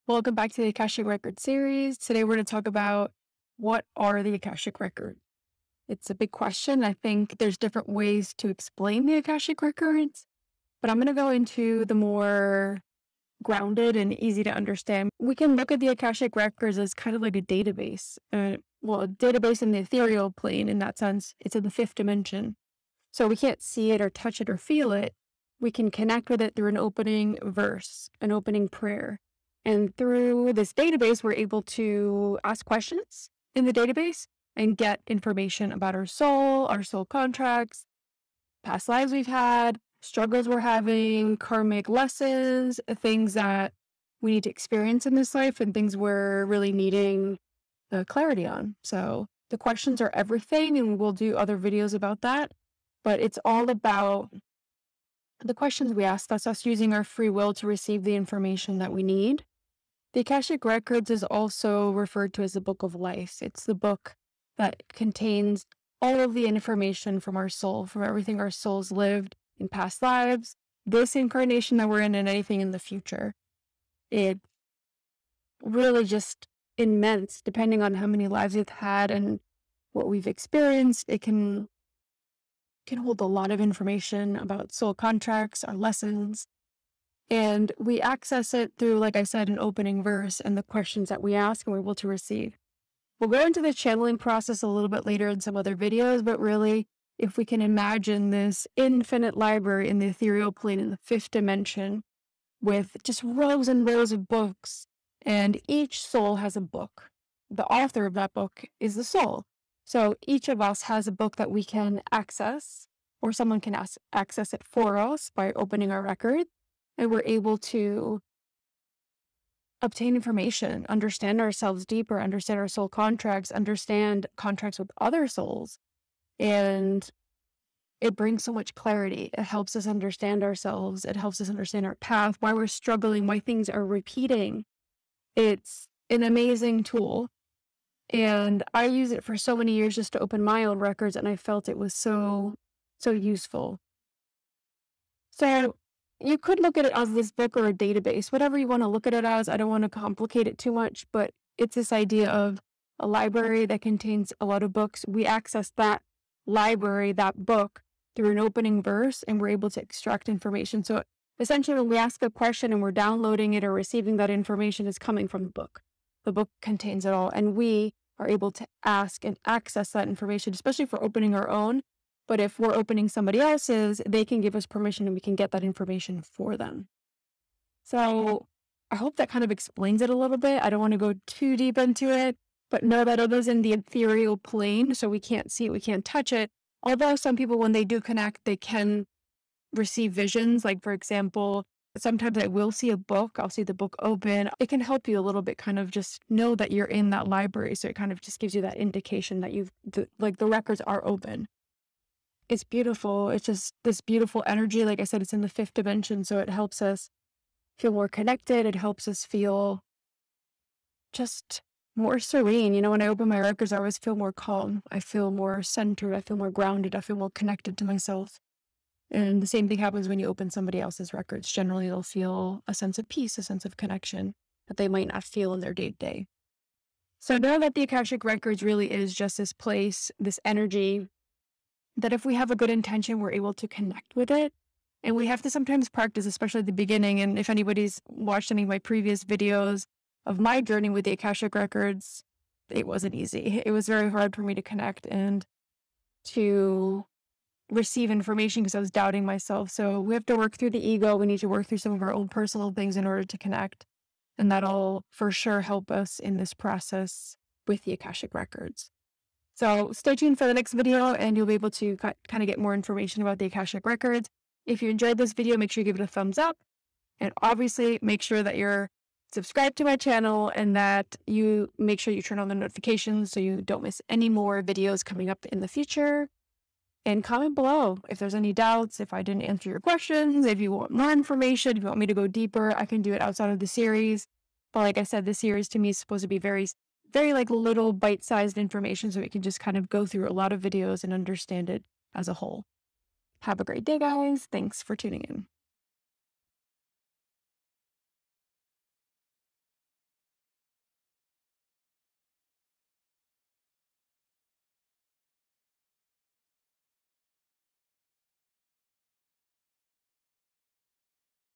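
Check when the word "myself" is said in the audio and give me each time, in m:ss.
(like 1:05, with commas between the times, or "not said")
3:37, 4:09.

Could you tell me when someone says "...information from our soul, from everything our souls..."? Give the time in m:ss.
1:06.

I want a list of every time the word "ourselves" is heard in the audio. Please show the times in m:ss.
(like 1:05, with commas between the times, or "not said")
2:01, 2:10.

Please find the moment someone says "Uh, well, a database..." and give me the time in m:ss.
0:18.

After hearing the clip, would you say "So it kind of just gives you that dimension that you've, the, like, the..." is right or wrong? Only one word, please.
wrong.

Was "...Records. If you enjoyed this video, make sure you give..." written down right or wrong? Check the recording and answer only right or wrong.
right.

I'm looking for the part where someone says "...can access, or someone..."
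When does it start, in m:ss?
1:51.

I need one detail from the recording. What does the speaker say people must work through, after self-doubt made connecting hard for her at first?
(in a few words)
The ego.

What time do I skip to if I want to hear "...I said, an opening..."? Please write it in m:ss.
1:29.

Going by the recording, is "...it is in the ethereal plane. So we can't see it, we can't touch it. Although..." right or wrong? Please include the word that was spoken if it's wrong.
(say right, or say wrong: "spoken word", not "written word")
right.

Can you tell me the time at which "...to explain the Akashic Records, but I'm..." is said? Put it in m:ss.
0:08.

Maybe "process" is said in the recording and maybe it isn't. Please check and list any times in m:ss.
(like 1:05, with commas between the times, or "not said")
1:34, 4:16.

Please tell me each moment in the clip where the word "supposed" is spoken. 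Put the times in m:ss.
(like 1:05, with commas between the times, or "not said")
4:45.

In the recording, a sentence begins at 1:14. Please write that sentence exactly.
It really just immense, depending on how many lives we've had and what we've experienced.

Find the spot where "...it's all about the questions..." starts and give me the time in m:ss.
0:53.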